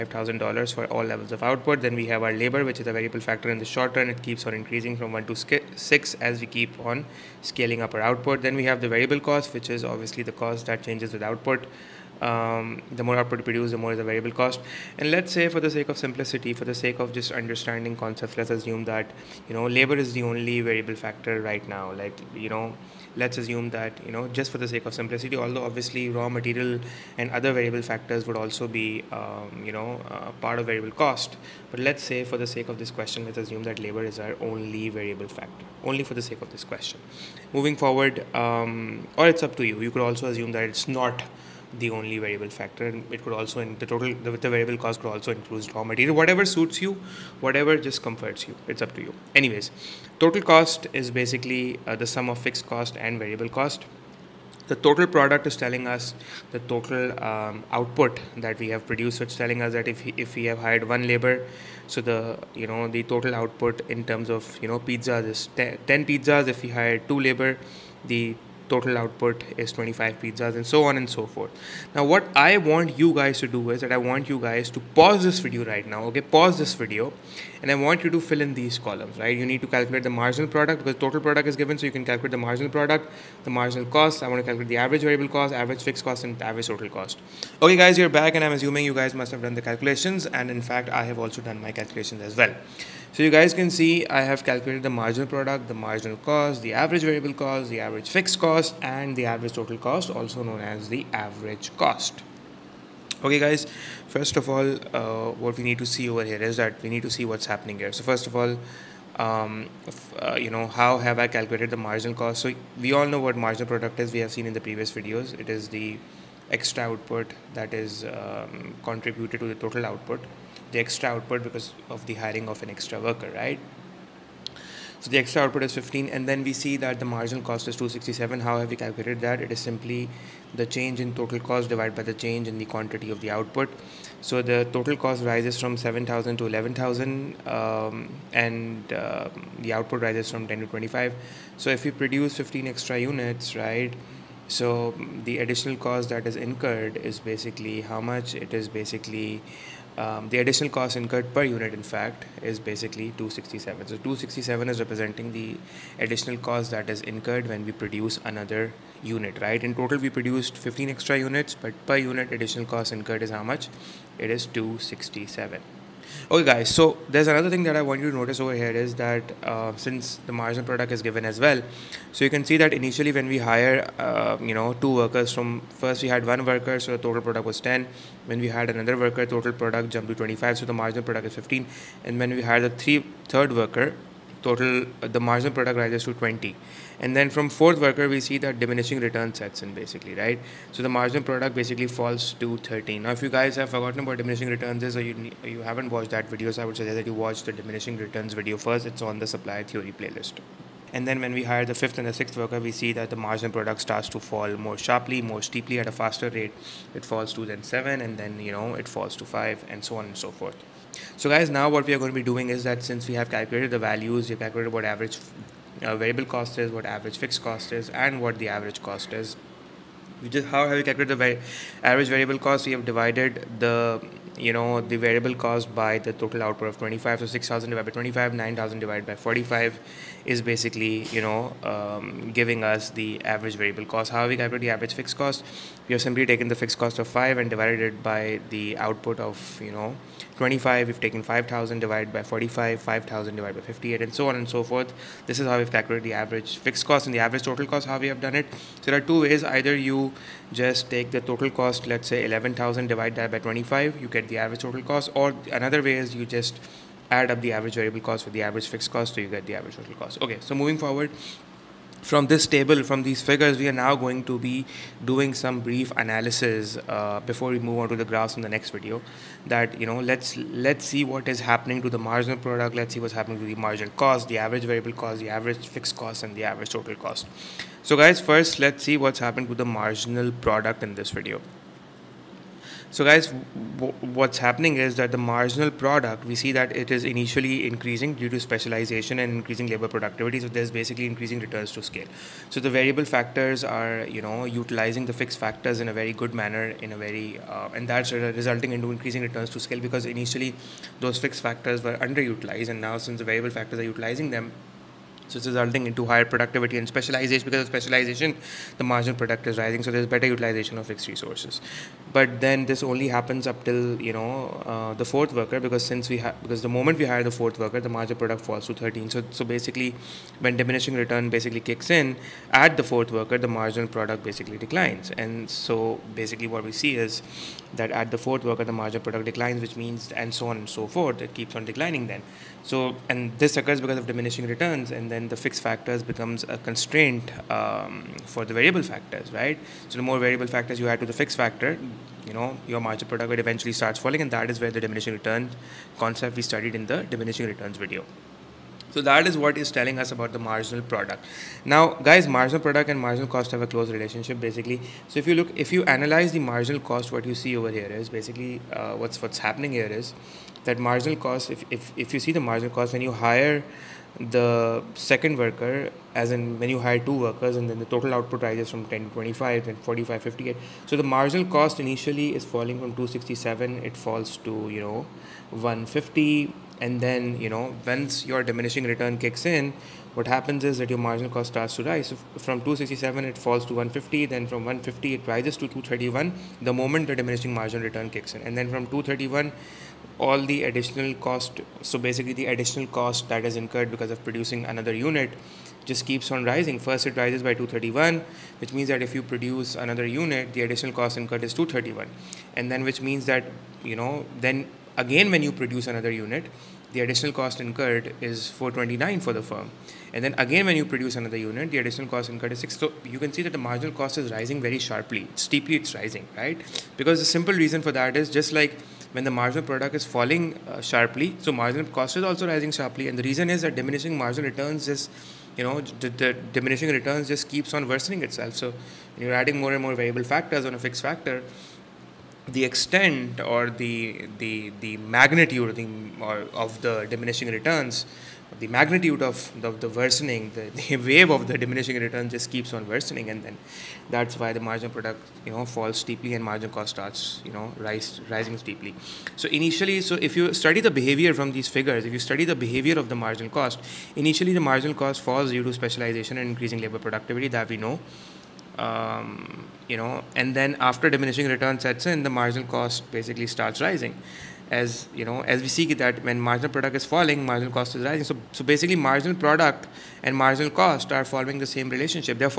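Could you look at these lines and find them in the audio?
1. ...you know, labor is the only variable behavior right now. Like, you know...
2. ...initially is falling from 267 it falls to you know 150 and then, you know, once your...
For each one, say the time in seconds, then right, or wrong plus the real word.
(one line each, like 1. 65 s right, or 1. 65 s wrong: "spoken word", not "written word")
1. 19 s wrong: "factor", not "behavior"
2. 371 s right.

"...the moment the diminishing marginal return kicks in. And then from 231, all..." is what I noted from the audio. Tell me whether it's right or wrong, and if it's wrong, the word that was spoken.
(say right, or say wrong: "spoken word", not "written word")
right.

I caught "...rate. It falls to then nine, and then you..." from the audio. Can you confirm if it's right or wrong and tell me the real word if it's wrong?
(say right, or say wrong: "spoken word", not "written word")
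wrong: "seven", not "nine".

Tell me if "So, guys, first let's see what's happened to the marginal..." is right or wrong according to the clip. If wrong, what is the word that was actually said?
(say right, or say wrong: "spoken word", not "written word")
right.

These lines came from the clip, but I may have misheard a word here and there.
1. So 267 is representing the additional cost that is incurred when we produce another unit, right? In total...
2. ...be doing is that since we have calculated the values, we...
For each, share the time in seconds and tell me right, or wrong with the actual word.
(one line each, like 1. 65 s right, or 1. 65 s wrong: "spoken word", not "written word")
1. 153 s right
2. 212 s right.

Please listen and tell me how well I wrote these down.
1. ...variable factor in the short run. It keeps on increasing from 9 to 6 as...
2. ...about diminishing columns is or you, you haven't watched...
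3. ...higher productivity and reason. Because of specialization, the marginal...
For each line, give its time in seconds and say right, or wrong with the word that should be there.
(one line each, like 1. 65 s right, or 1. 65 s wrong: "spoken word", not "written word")
1. 2 s wrong: "1", not "9"
2. 194 s wrong: "returns", not "columns"
3. 306 s wrong: "specialization", not "reason".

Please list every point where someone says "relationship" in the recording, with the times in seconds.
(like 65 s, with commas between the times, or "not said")
353 s, 471 s.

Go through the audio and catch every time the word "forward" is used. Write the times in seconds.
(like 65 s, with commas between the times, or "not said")
37 s, 260 s.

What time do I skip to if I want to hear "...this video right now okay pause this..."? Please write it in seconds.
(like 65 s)
75 s.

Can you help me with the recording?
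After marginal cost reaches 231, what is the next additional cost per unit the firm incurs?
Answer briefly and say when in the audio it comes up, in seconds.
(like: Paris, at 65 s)
429, at 408 s.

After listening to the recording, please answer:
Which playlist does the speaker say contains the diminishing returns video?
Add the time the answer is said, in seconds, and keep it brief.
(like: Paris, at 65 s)
supply theory playlist, at 199 s.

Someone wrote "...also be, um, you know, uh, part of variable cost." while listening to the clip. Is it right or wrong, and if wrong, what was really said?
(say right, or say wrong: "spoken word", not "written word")
right.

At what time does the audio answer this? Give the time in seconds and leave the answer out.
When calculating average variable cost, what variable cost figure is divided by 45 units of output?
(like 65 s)
228 s.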